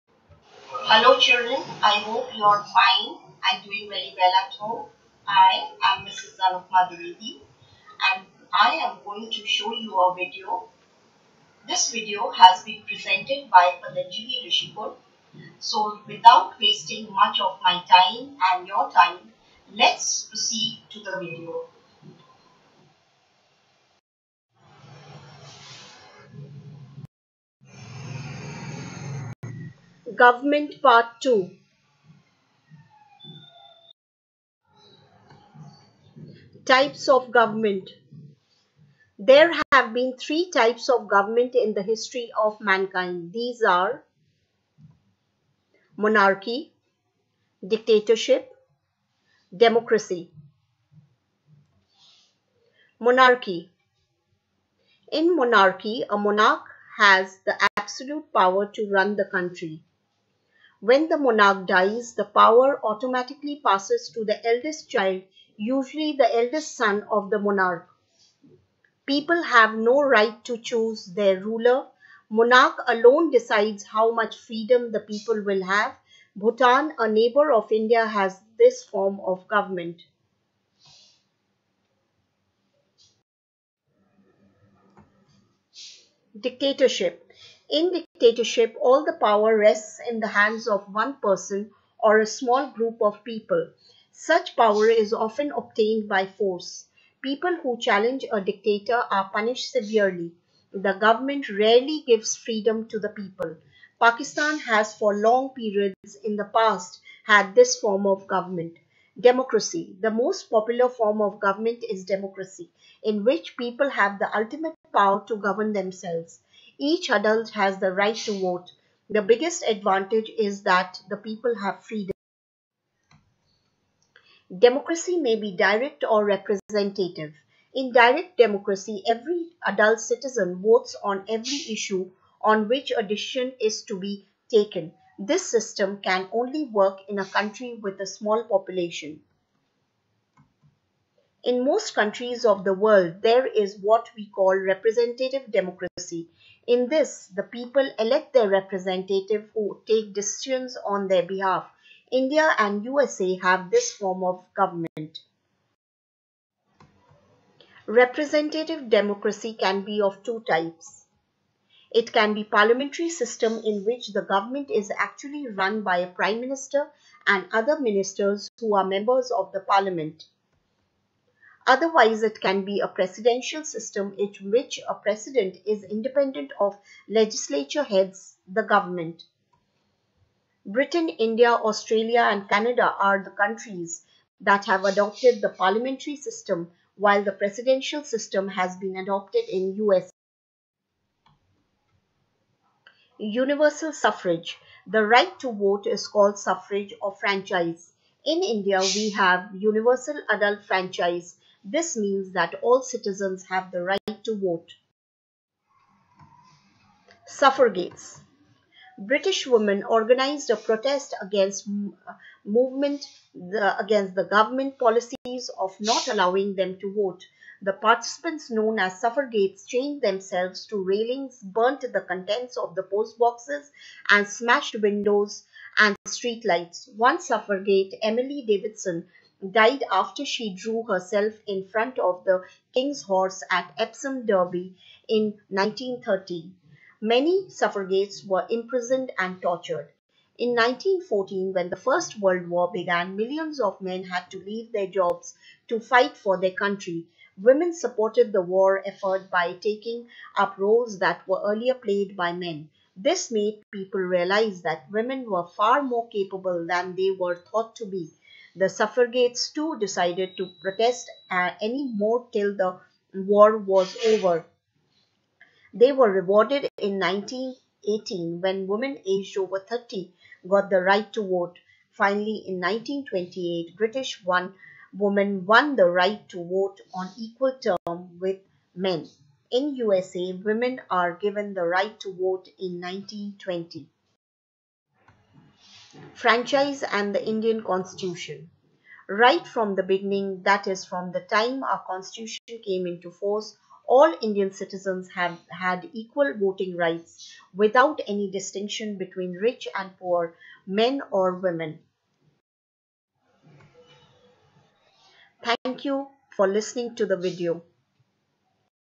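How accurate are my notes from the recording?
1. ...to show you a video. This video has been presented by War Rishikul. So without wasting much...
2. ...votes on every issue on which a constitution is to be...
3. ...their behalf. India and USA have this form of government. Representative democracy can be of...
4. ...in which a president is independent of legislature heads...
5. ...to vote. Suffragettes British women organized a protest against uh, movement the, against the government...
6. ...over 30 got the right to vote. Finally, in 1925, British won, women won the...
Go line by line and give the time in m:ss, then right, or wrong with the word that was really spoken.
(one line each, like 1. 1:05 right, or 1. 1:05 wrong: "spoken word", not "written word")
1. 0:09 wrong: "Patanjali", not "War"
2. 2:10 wrong: "decision", not "constitution"
3. 2:31 right
4. 2:54 right
5. 3:24 right
6. 4:29 wrong: "1928", not "1925".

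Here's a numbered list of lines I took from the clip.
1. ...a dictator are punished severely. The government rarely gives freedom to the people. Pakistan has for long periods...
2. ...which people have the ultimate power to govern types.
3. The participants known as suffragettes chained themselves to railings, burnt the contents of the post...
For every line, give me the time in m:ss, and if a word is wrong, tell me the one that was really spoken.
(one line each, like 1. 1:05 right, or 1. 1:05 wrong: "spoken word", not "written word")
1. 1:38 right
2. 1:53 wrong: "themselves", not "types"
3. 3:37 right.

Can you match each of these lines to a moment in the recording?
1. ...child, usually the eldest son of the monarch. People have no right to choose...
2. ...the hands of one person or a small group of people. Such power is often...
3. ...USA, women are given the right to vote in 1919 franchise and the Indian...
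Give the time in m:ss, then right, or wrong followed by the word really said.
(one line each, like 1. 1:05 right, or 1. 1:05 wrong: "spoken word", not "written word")
1. 1:04 right
2. 1:30 right
3. 4:39 wrong: "1920", not "1919".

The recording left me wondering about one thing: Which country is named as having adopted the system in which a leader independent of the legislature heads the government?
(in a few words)
US.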